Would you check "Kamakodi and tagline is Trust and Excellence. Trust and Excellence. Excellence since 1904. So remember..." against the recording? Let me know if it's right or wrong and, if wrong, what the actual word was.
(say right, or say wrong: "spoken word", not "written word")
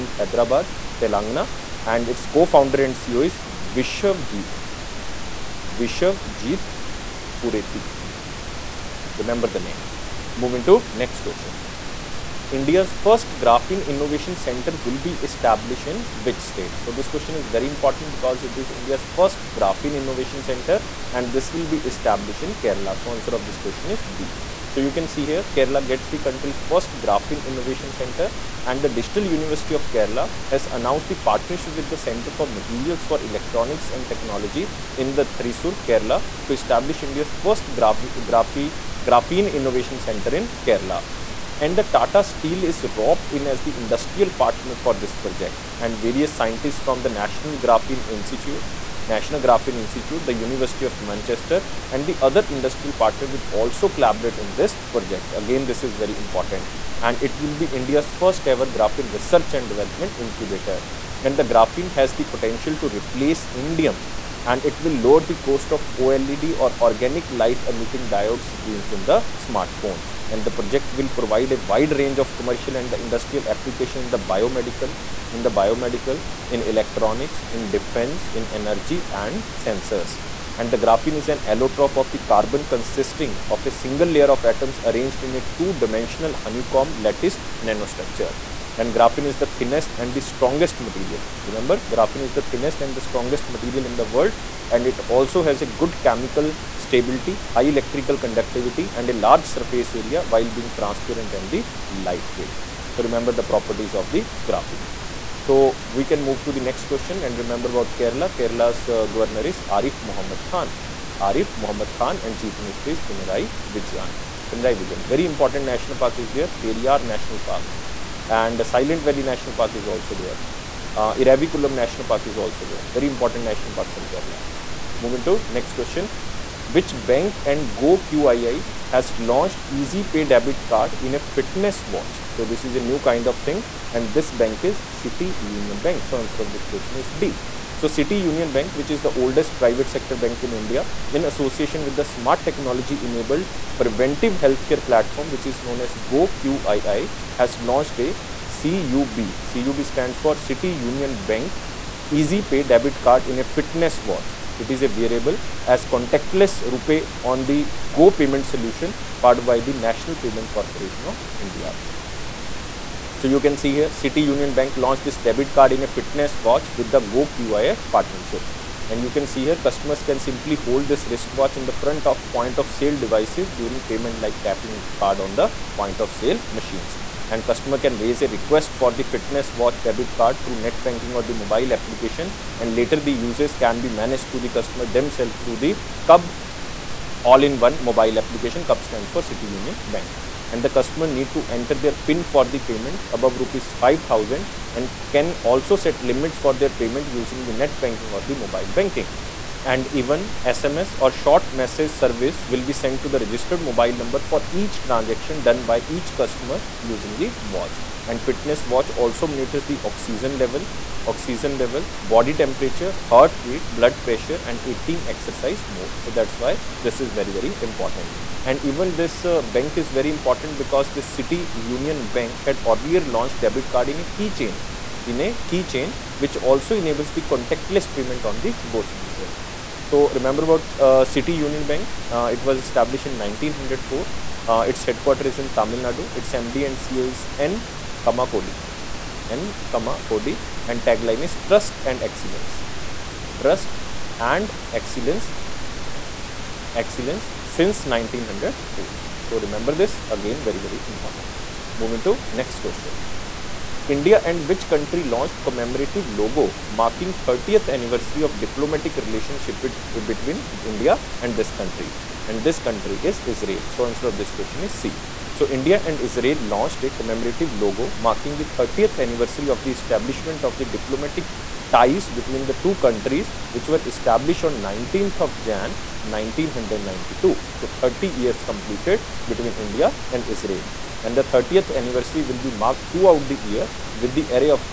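right.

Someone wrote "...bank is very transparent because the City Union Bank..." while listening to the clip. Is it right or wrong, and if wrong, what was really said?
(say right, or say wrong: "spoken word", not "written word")
wrong: "important", not "transparent".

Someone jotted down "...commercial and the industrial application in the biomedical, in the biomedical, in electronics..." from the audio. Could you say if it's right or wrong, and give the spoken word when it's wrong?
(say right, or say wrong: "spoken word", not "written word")
right.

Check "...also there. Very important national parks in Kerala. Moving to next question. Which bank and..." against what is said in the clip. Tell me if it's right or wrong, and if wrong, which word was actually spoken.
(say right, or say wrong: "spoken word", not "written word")
right.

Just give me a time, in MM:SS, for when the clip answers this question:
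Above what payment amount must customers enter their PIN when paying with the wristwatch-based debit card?
03:13.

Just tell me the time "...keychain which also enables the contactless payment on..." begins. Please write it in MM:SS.
03:45.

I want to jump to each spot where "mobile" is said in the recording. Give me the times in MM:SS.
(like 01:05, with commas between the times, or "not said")
03:01, 03:07, 03:18, 03:23.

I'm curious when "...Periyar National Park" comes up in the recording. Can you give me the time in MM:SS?
01:56.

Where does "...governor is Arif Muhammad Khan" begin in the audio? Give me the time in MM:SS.
01:49.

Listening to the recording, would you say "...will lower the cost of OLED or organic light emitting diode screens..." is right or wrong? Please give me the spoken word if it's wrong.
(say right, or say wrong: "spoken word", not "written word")
right.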